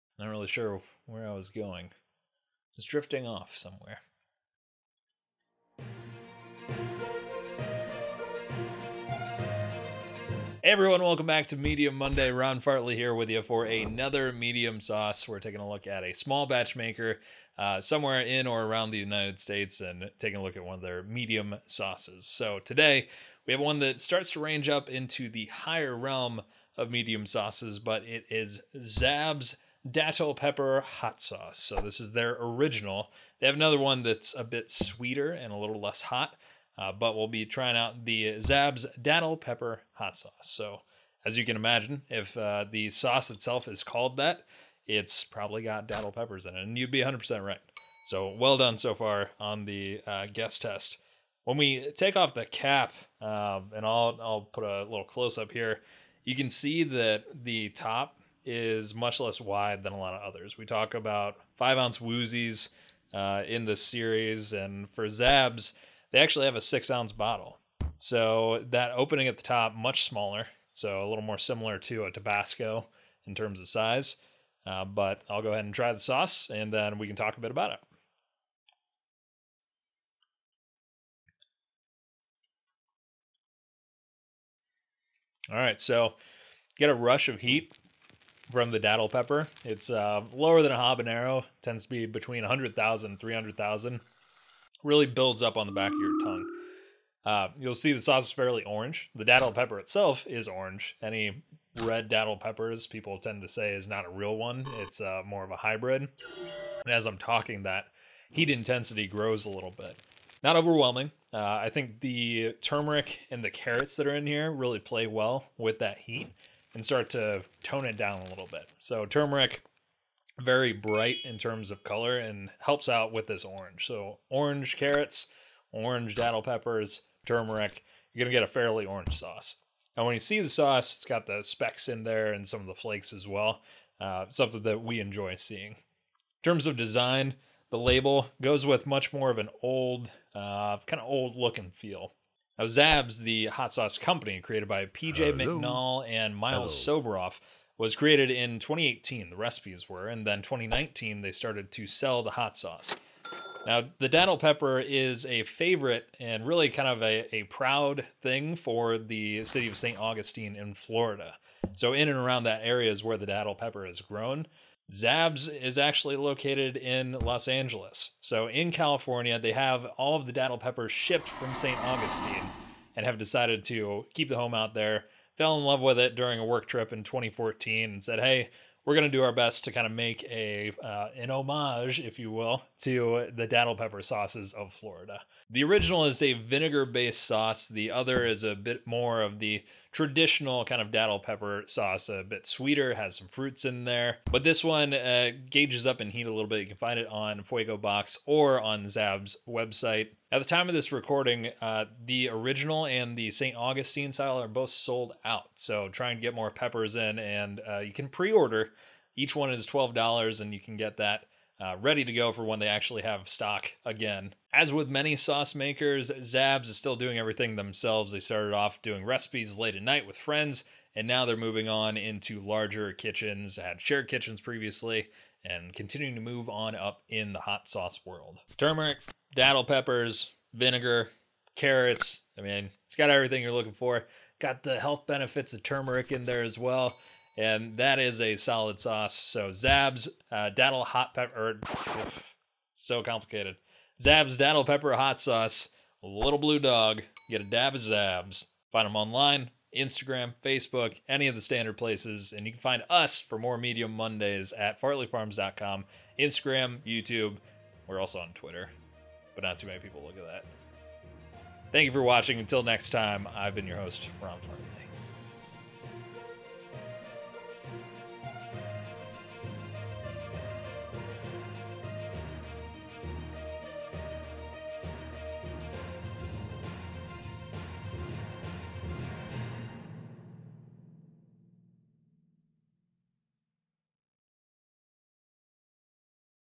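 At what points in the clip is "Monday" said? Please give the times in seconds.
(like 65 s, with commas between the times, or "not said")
11 s, 253 s.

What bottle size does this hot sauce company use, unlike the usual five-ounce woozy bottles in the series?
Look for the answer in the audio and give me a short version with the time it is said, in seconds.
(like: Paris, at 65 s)
6 ounces, at 66 s.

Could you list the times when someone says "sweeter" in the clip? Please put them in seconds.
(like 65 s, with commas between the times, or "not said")
34 s, 192 s.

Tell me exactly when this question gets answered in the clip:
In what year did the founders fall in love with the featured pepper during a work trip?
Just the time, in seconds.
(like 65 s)
177 s.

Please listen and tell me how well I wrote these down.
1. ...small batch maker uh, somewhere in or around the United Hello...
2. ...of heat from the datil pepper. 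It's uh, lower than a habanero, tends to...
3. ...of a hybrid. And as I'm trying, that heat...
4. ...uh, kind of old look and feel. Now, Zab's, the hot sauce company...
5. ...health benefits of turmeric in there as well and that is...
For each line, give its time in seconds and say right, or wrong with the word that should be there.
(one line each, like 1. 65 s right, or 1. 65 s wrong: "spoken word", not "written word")
1. 16 s wrong: "States", not "Hello"
2. 87 s right
3. 105 s wrong: "talking", not "trying"
4. 140 s right
5. 234 s right.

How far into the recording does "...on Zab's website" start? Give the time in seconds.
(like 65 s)
198 s.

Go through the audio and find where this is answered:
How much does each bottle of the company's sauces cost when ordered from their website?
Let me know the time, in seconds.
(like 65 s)
209 s.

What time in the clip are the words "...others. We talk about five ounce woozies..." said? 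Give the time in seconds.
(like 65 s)
60 s.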